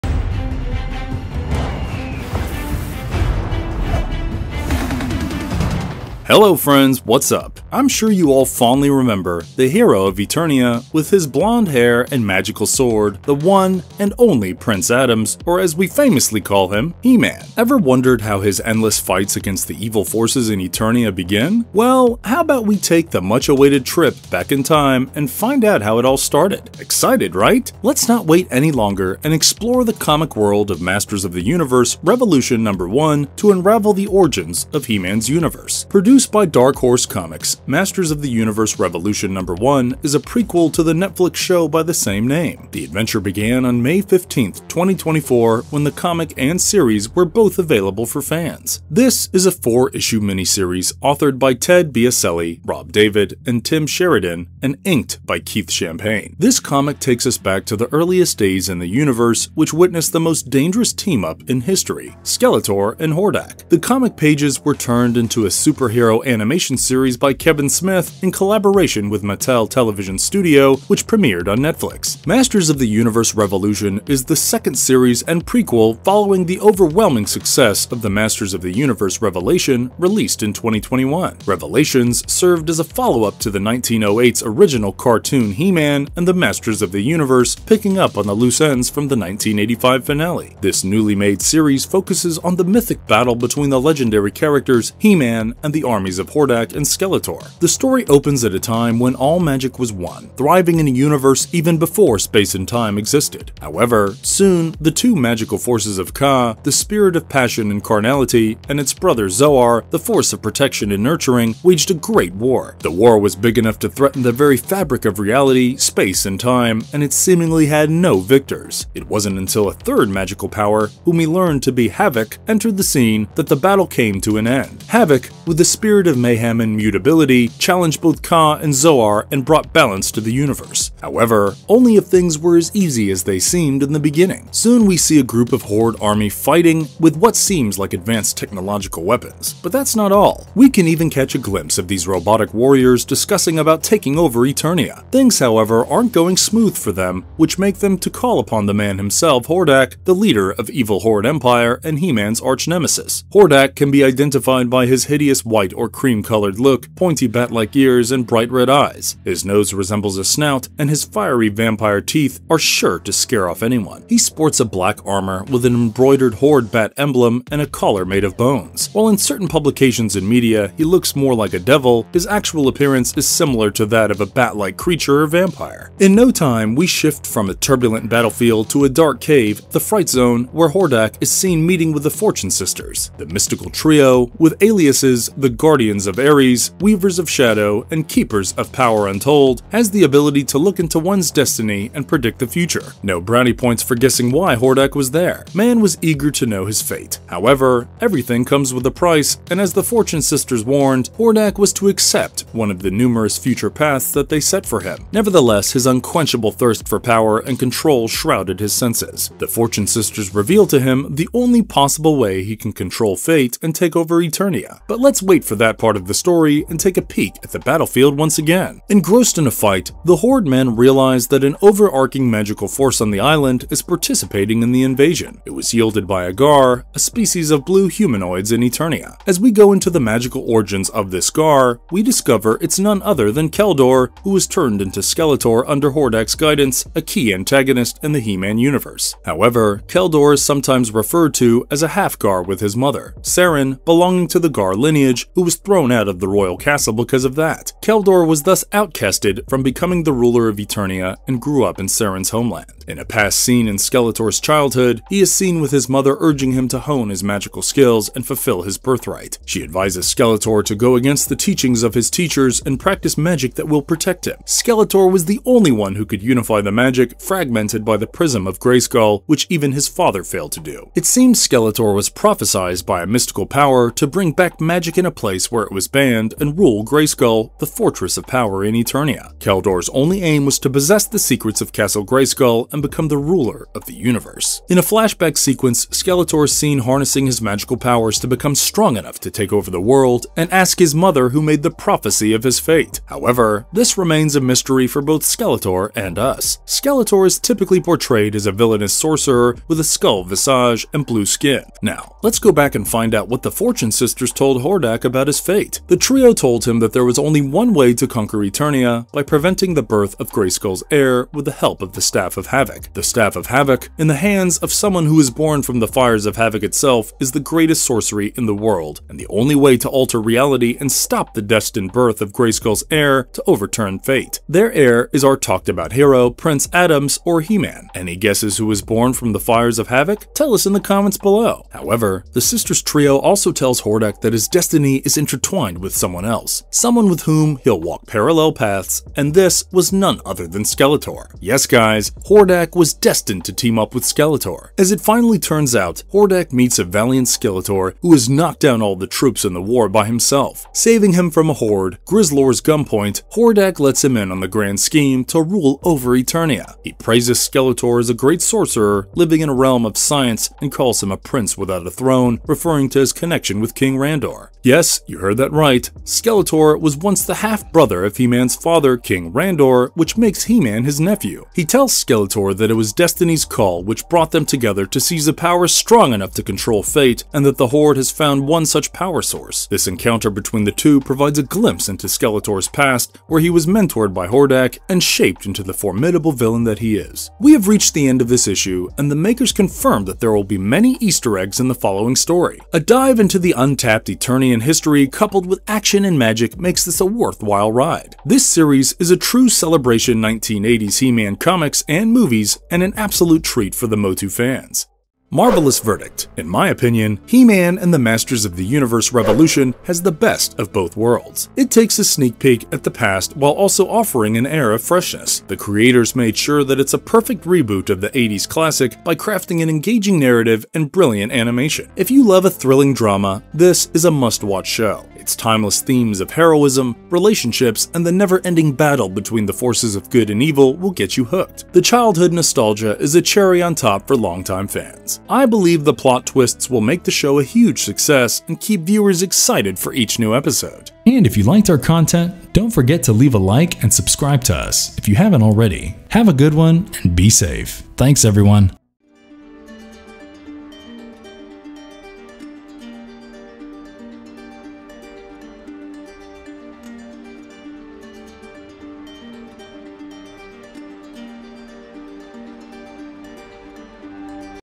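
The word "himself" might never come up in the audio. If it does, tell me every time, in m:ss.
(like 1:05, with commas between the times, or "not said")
2:28, 5:50.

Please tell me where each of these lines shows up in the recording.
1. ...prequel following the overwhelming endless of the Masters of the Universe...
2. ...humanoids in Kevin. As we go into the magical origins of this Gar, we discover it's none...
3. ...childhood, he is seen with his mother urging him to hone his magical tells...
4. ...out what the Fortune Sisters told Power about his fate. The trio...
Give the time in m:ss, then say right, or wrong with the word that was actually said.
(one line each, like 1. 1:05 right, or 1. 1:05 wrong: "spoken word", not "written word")
1. 1:15 wrong: "success", not "endless"
2. 3:47 wrong: "Eternia", not "Kevin"
3. 4:14 wrong: "skills", not "tells"
4. 5:03 wrong: "Hordak", not "Power".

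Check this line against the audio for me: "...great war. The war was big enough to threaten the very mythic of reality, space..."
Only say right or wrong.
wrong.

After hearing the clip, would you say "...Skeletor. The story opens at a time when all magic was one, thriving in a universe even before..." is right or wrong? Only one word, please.
right.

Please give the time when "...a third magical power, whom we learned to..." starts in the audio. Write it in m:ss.
1:59.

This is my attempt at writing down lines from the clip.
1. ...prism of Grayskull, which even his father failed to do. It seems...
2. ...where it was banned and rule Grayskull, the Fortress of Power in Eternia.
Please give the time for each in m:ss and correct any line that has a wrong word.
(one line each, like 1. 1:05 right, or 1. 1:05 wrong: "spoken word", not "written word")
1. 4:28 right
2. 4:35 right.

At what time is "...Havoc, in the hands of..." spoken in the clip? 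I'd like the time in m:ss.
5:13.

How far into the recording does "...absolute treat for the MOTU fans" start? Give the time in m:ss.
6:42.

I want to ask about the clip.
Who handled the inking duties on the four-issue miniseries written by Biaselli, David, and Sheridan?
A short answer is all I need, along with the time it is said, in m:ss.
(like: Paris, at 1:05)
Keith Champagne, at 0:55.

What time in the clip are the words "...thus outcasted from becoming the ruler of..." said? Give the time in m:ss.
4:08.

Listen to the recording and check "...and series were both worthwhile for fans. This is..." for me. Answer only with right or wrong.
wrong.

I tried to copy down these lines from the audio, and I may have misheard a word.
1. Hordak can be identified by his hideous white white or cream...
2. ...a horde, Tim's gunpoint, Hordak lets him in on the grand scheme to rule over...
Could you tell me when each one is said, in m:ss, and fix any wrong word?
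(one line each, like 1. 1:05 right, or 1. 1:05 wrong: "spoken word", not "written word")
1. 2:33 right
2. 5:51 wrong: "Grizzlor", not "Tim".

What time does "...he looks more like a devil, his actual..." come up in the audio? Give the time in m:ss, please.
2:50.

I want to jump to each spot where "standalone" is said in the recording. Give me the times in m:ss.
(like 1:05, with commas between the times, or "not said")
not said.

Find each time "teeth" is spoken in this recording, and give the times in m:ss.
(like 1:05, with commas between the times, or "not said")
2:42.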